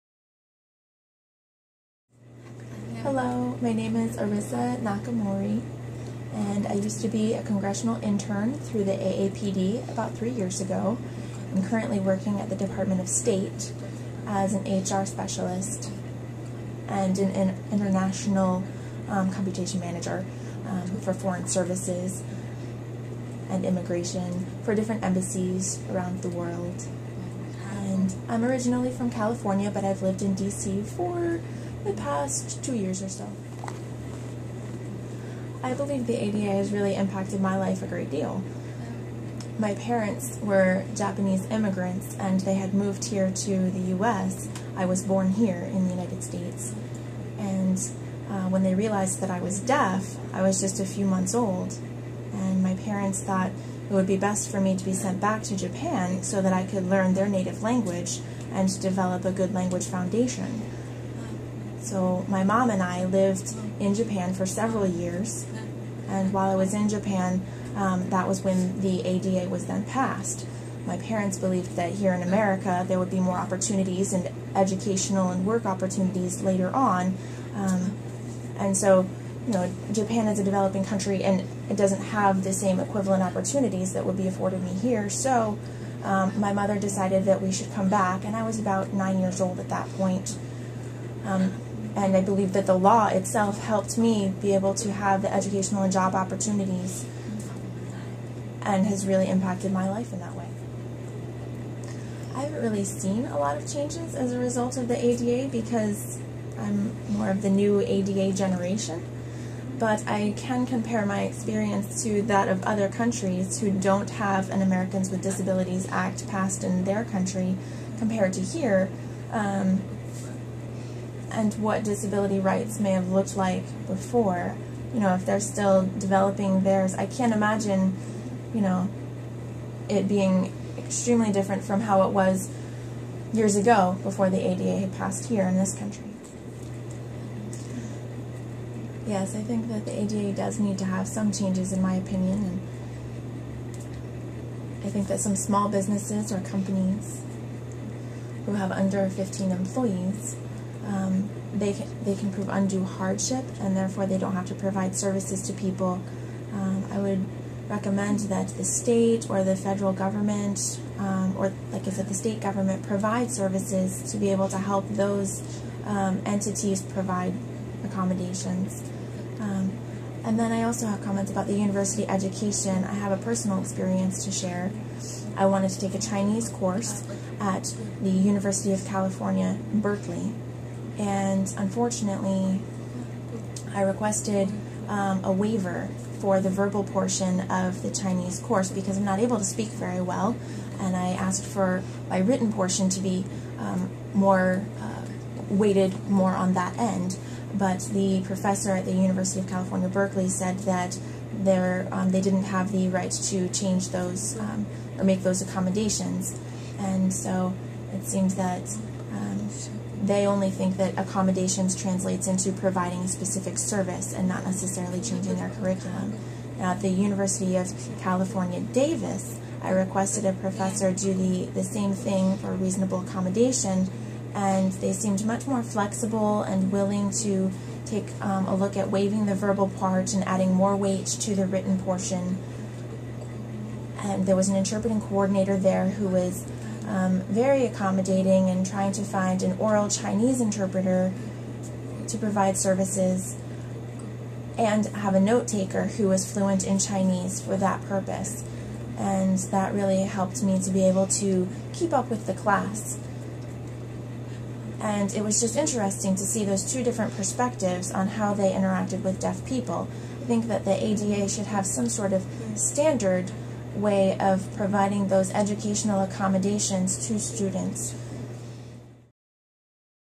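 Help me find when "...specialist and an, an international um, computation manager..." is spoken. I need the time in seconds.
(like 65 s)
15 s.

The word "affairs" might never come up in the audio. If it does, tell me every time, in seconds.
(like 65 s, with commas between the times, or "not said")
not said.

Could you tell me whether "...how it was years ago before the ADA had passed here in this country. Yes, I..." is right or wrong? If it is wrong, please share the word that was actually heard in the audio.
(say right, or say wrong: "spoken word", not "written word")
right.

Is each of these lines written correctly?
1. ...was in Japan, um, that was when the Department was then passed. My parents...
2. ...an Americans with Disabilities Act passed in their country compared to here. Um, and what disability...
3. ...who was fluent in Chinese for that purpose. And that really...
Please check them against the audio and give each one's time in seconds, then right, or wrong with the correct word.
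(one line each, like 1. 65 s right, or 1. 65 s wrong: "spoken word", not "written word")
1. 66 s wrong: "ADA", not "Department"
2. 114 s right
3. 245 s right.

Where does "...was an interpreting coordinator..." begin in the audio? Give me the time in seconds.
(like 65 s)
234 s.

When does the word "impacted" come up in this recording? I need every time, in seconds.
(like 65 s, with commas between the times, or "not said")
36 s, 99 s.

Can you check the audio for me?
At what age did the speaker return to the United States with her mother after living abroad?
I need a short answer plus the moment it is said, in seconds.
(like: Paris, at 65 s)
9, at 88 s.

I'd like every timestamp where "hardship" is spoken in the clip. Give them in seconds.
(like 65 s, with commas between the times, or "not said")
152 s.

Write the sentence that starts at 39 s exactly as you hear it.
My parents were Japanese immigrants and they had moved here to the US.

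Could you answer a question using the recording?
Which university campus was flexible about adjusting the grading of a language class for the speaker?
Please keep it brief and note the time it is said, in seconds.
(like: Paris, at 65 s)
University of California, Davis, at 216 s.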